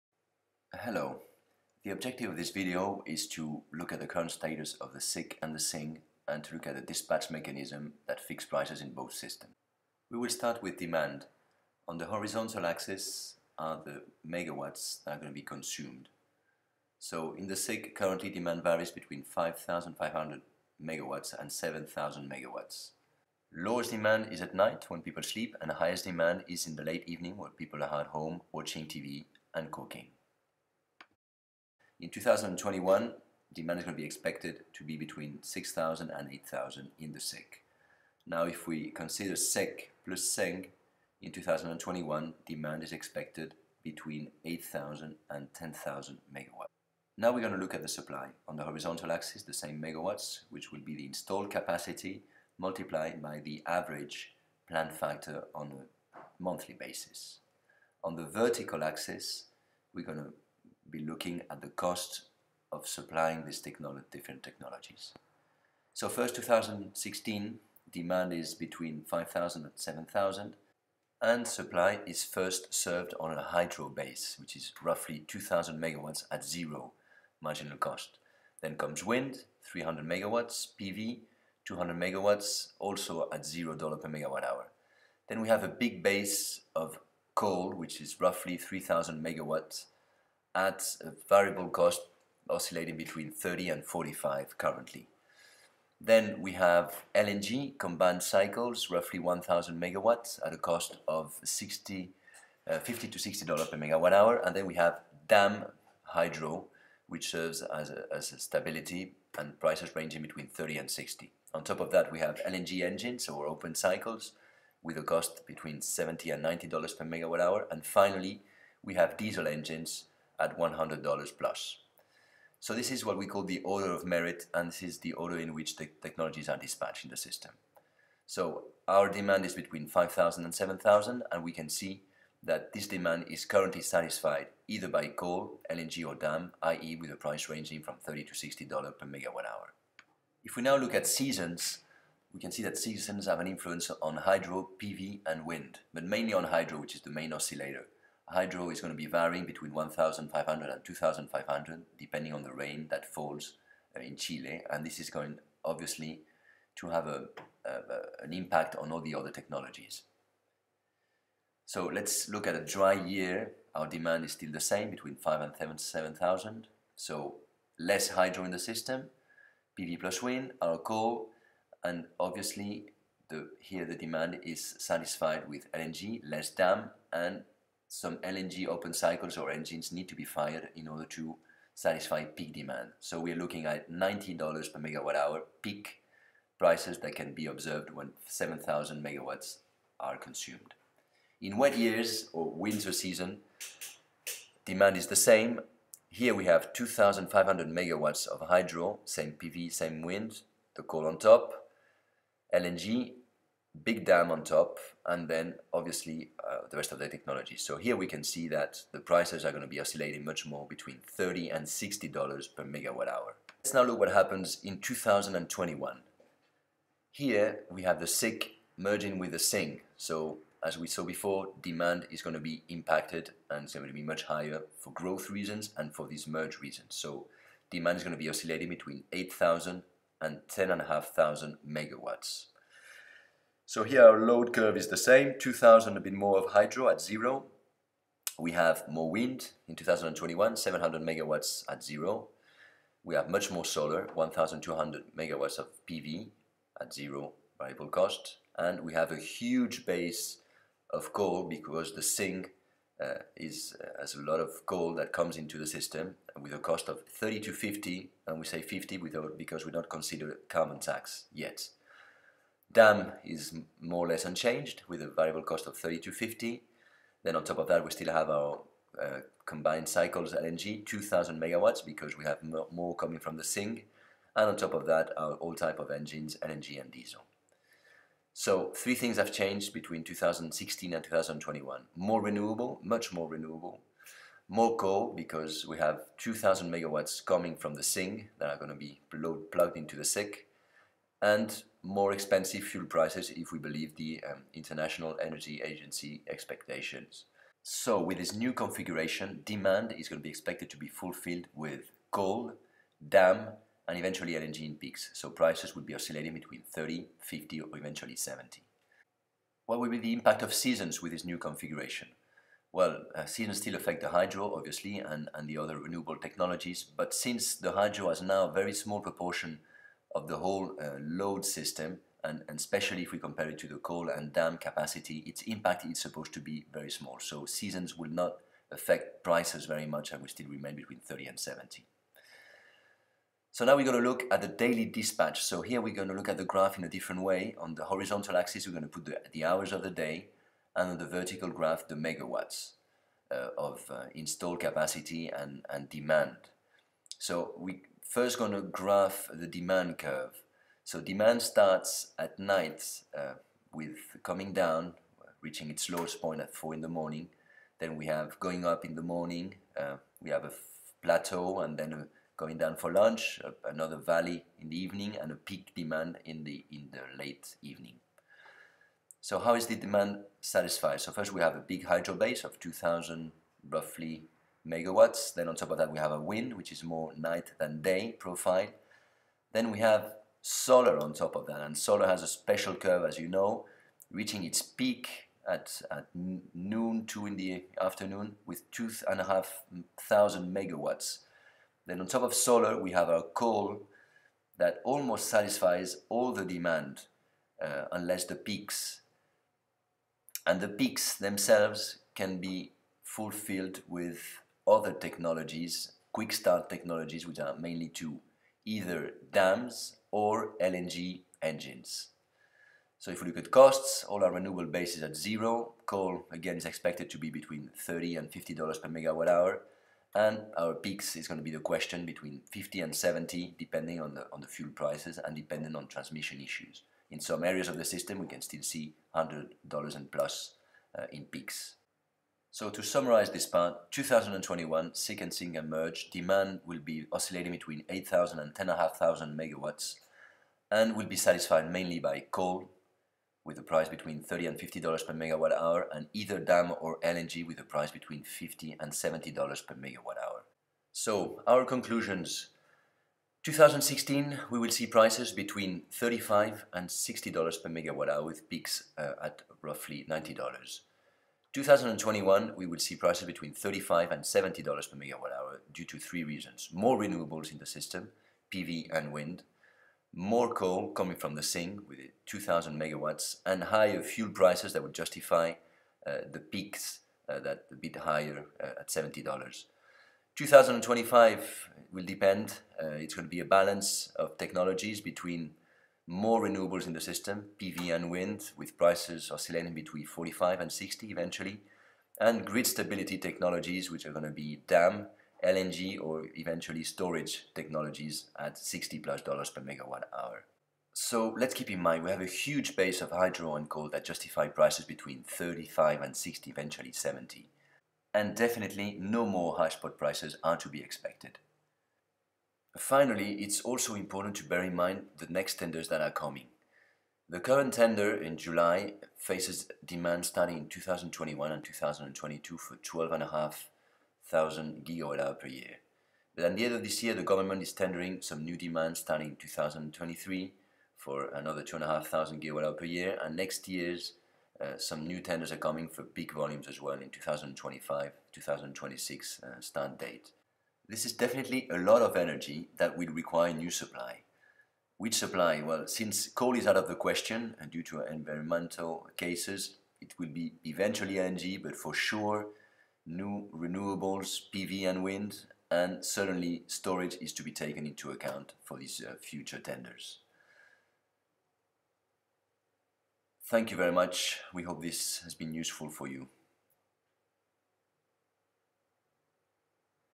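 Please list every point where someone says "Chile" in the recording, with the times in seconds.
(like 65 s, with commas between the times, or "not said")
154 s.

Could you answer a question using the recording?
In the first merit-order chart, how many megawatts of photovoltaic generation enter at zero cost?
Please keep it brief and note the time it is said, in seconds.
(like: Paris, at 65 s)
200 megawatts, at 80 s.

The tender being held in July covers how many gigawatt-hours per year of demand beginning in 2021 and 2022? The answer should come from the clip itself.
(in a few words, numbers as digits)
12,500 GWh per year.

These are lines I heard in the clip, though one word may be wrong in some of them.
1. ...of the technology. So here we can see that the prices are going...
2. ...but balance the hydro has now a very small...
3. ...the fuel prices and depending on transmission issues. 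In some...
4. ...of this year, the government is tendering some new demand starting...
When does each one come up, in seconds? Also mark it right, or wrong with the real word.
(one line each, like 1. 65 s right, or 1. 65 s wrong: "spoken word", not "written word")
1. 206 s right
2. 316 s wrong: "since", not "balance"
3. 424 s right
4. 526 s right.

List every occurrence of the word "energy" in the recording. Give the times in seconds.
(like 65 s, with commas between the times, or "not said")
295 s, 542 s.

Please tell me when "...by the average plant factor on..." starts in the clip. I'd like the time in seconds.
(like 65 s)
53 s.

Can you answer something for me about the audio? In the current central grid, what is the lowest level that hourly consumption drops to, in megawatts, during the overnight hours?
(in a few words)
5,500 megawatts.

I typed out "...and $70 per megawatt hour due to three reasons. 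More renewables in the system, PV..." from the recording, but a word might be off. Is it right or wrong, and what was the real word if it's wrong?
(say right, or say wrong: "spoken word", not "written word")
right.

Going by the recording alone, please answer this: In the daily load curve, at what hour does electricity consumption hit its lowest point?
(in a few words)
4 in the morning.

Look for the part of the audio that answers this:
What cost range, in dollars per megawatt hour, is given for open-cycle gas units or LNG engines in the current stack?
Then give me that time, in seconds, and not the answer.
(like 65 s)
115 s.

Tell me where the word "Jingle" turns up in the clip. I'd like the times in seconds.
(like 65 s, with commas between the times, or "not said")
not said.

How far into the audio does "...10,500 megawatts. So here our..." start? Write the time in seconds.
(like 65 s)
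230 s.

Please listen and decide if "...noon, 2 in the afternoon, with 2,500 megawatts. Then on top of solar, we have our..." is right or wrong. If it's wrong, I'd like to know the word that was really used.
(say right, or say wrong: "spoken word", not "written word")
right.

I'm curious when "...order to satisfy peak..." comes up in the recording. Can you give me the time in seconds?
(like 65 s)
180 s.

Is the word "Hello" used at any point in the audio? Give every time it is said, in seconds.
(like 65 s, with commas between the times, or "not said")
0 s.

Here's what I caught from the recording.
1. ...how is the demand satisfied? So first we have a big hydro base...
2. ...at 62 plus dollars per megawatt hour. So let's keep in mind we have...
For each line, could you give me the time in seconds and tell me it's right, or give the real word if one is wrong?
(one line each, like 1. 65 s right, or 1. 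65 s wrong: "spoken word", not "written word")
1. 369 s right
2. 498 s wrong: "60", not "62".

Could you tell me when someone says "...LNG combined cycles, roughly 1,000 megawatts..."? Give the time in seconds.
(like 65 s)
97 s.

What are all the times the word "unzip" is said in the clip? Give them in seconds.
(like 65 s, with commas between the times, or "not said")
not said.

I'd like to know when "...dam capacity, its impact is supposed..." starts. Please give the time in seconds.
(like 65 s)
324 s.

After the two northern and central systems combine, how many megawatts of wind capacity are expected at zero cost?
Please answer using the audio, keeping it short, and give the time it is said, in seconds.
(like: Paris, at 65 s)
700 megawatts, at 240 s.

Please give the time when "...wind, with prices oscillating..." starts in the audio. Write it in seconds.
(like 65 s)
488 s.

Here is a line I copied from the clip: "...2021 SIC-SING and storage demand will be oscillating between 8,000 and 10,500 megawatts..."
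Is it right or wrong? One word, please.
wrong.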